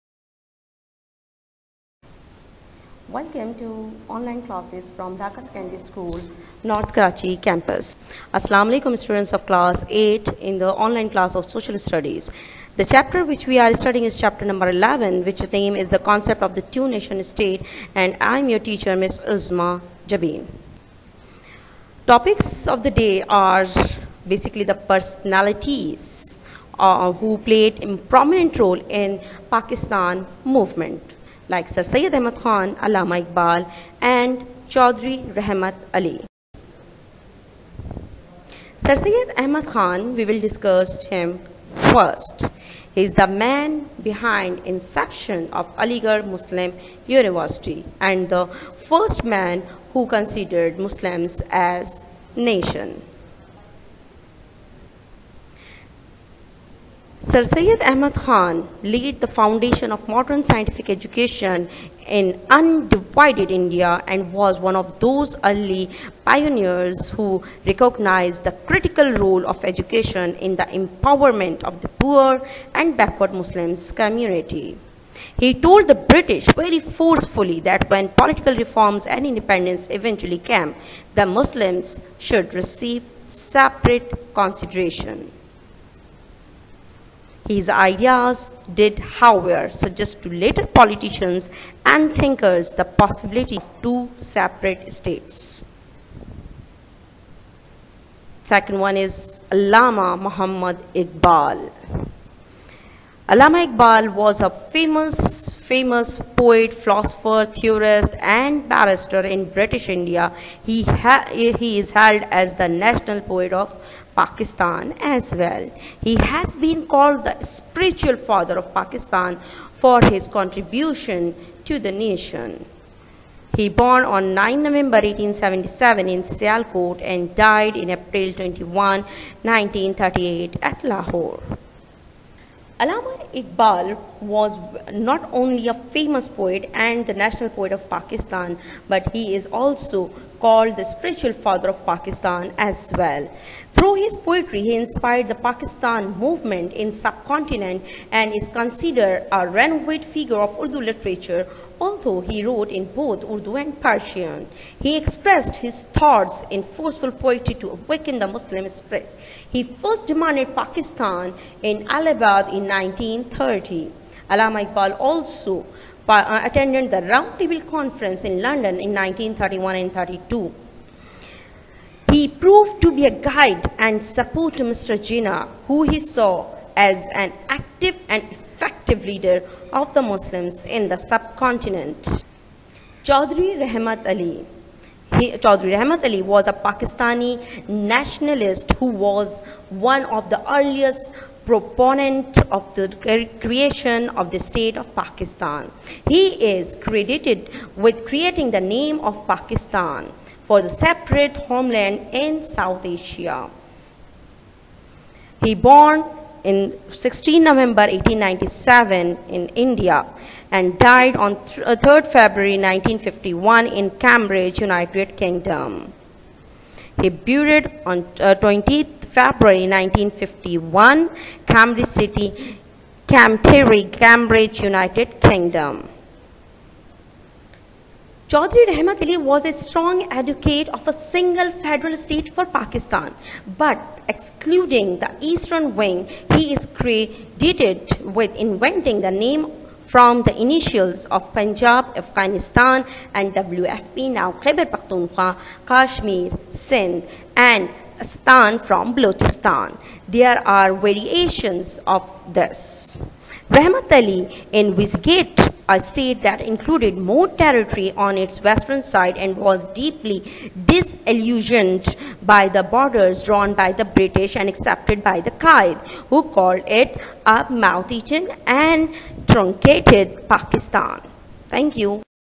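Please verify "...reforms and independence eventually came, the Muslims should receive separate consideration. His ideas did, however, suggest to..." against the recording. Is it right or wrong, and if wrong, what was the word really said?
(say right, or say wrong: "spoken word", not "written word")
right.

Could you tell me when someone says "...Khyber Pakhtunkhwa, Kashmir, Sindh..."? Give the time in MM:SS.
04:04.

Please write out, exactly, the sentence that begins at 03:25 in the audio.
He born in 16 November 1897 in India and died on 3rd uh, February 1951 in Cambridge, United Kingdom.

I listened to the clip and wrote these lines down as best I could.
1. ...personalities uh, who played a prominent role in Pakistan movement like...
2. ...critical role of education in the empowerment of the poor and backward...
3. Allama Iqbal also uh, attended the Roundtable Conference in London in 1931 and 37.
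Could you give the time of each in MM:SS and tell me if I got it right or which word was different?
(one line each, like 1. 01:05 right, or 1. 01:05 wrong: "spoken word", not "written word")
1. 00:24 right
2. 01:08 right
3. 02:44 wrong: "32", not "37".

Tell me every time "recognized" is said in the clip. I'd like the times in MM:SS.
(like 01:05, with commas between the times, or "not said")
01:07.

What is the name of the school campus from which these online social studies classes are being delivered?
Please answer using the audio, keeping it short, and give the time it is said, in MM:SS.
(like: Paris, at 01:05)
North Karachi, at 00:06.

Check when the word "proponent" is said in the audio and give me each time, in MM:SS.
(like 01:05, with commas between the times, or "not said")
03:11.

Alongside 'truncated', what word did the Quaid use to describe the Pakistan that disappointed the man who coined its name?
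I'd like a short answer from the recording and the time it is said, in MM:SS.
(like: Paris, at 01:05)
mouth-eaten, at 04:27.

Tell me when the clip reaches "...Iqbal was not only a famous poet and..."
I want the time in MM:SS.
02:13.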